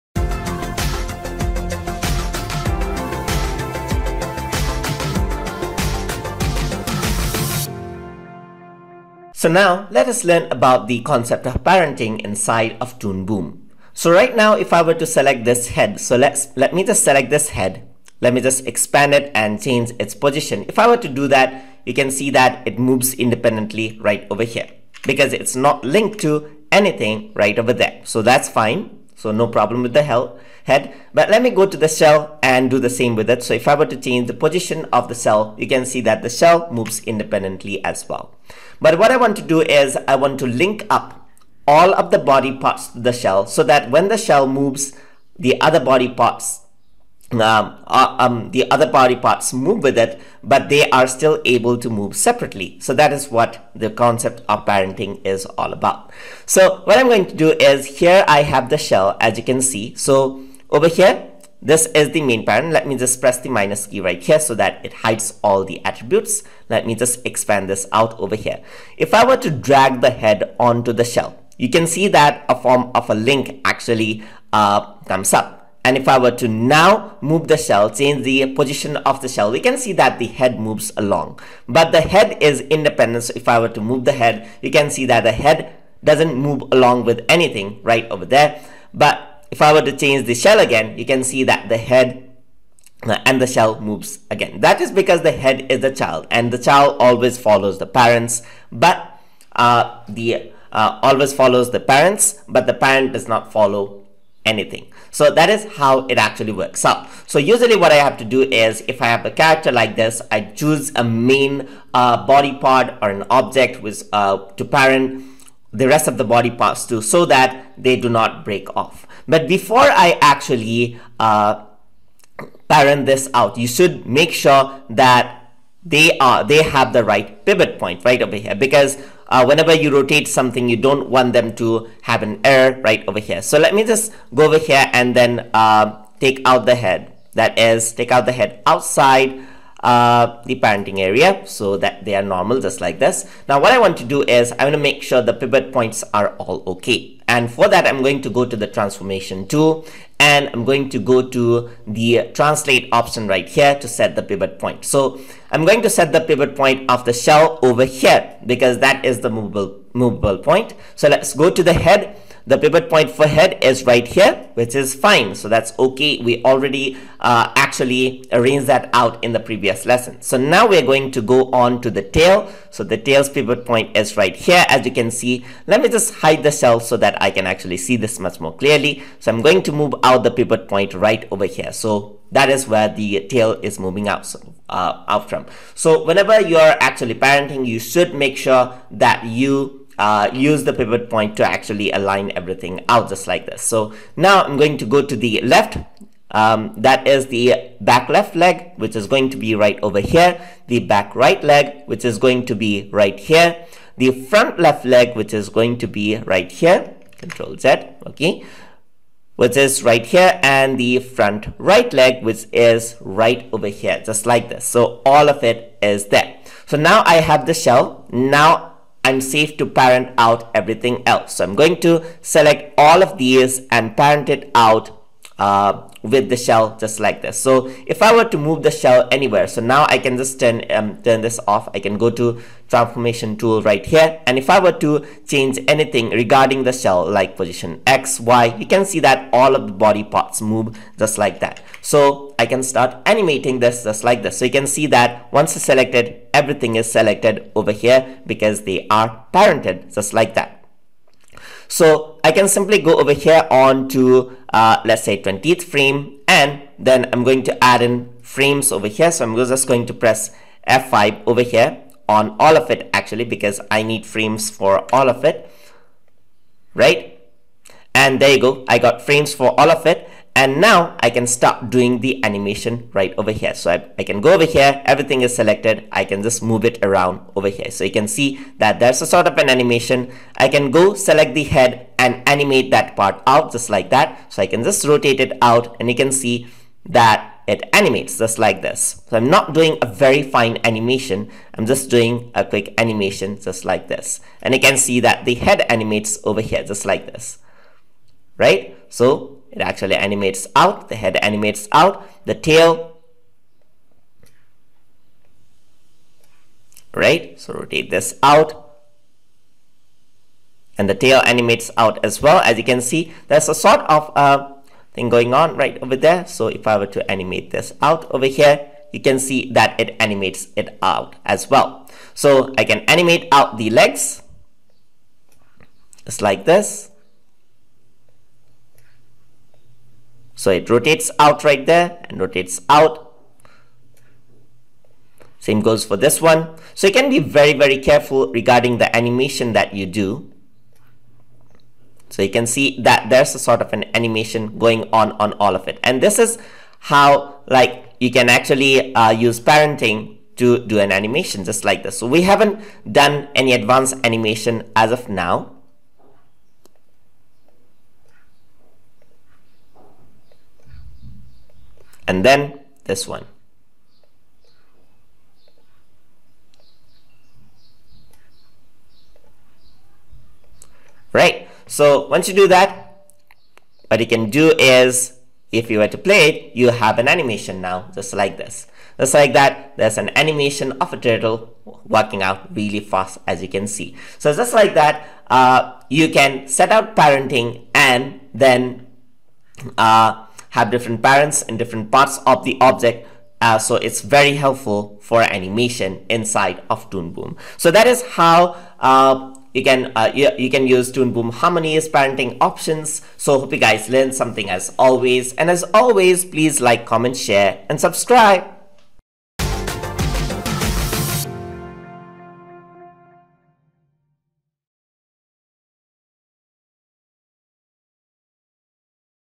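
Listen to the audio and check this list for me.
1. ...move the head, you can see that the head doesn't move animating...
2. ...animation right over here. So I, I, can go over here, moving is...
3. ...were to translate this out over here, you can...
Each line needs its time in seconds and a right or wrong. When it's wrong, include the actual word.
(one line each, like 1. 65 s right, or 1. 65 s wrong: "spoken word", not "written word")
1. 83 s wrong: "along", not "animating"
2. 272 s wrong: "everything", not "moving"
3. 316 s wrong: "animate", not "translate".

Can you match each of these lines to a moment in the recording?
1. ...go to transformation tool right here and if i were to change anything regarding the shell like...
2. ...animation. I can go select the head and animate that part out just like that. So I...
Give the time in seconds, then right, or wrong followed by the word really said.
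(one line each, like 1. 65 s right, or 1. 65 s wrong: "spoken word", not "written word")
1. 231 s right
2. 279 s right.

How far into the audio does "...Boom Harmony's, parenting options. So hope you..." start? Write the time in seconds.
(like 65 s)
401 s.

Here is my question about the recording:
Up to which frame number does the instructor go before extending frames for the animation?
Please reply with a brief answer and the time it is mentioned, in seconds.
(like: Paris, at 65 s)
20, at 255 s.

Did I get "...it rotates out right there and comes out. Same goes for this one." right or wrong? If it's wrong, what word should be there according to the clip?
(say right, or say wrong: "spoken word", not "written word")
wrong: "rotates", not "comes".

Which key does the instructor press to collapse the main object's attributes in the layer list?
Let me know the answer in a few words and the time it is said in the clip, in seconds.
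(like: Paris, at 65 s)
Minus key, at 63 s.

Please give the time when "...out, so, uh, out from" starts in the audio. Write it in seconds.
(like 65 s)
184 s.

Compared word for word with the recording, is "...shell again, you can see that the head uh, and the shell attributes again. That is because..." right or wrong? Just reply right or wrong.
wrong.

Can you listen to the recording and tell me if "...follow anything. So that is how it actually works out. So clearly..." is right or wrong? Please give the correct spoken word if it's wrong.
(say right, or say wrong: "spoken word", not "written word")
wrong: "usually", not "clearly".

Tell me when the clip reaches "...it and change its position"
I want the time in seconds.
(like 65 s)
19 s.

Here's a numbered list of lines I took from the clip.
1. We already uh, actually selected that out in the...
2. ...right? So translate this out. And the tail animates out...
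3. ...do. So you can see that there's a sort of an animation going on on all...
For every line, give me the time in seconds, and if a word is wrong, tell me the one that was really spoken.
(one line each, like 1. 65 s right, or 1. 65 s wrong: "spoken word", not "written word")
1. 166 s wrong: "arranged", not "selected"
2. 306 s wrong: "rotate", not "translate"
3. 339 s right.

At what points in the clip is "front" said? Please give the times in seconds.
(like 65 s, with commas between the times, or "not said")
204 s, 210 s.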